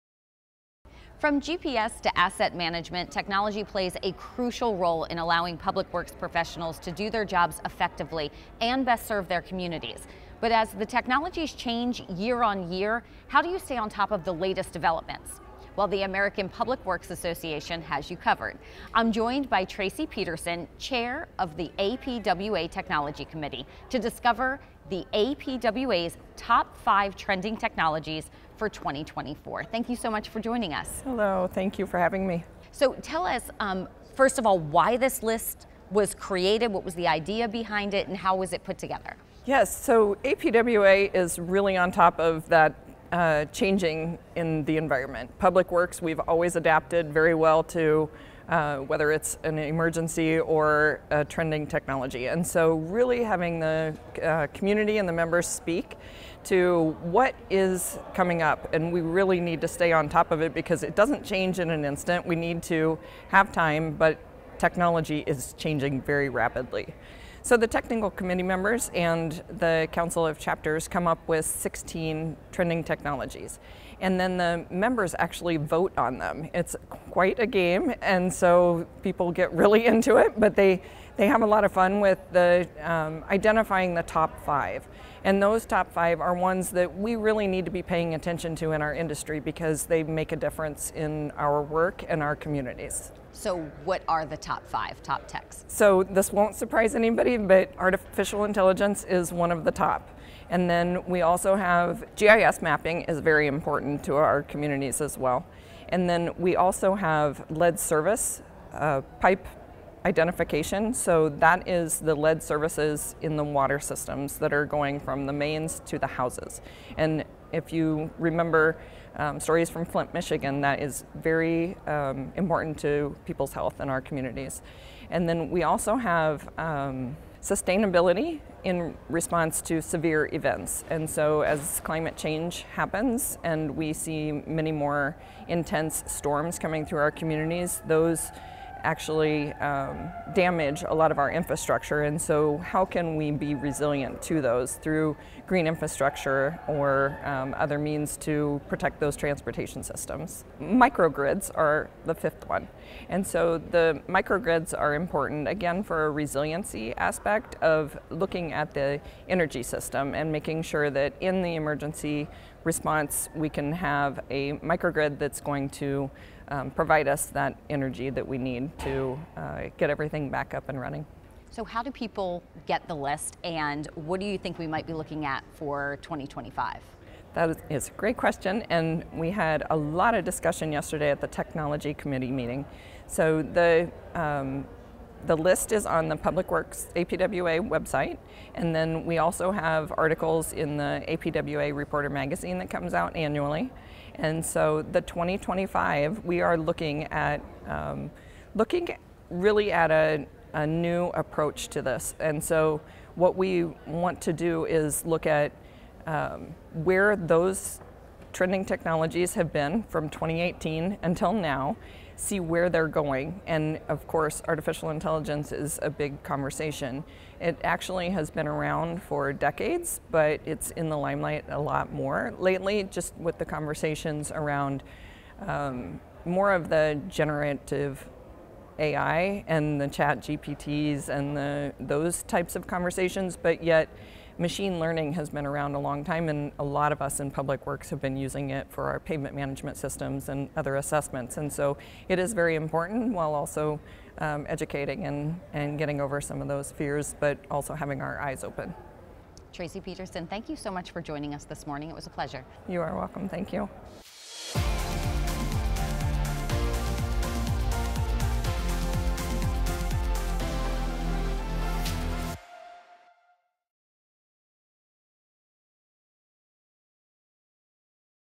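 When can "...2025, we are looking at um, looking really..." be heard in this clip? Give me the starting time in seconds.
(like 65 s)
195 s.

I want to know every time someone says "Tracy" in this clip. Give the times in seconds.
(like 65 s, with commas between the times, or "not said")
19 s, 249 s.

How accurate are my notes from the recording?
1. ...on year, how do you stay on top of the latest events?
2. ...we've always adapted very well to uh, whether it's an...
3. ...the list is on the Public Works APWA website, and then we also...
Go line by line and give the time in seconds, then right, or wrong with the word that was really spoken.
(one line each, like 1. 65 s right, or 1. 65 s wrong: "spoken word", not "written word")
1. 12 s wrong: "developments", not "events"
2. 46 s right
3. 185 s right.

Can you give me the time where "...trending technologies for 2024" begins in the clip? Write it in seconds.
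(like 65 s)
27 s.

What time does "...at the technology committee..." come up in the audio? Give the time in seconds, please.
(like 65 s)
181 s.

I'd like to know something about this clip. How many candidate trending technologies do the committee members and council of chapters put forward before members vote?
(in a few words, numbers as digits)
16.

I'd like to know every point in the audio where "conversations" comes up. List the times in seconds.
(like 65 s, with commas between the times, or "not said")
216 s, 223 s, 232 s.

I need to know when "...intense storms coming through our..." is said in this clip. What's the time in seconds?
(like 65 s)
135 s.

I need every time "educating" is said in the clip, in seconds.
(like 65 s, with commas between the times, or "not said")
244 s.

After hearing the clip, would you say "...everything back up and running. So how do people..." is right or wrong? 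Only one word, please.
right.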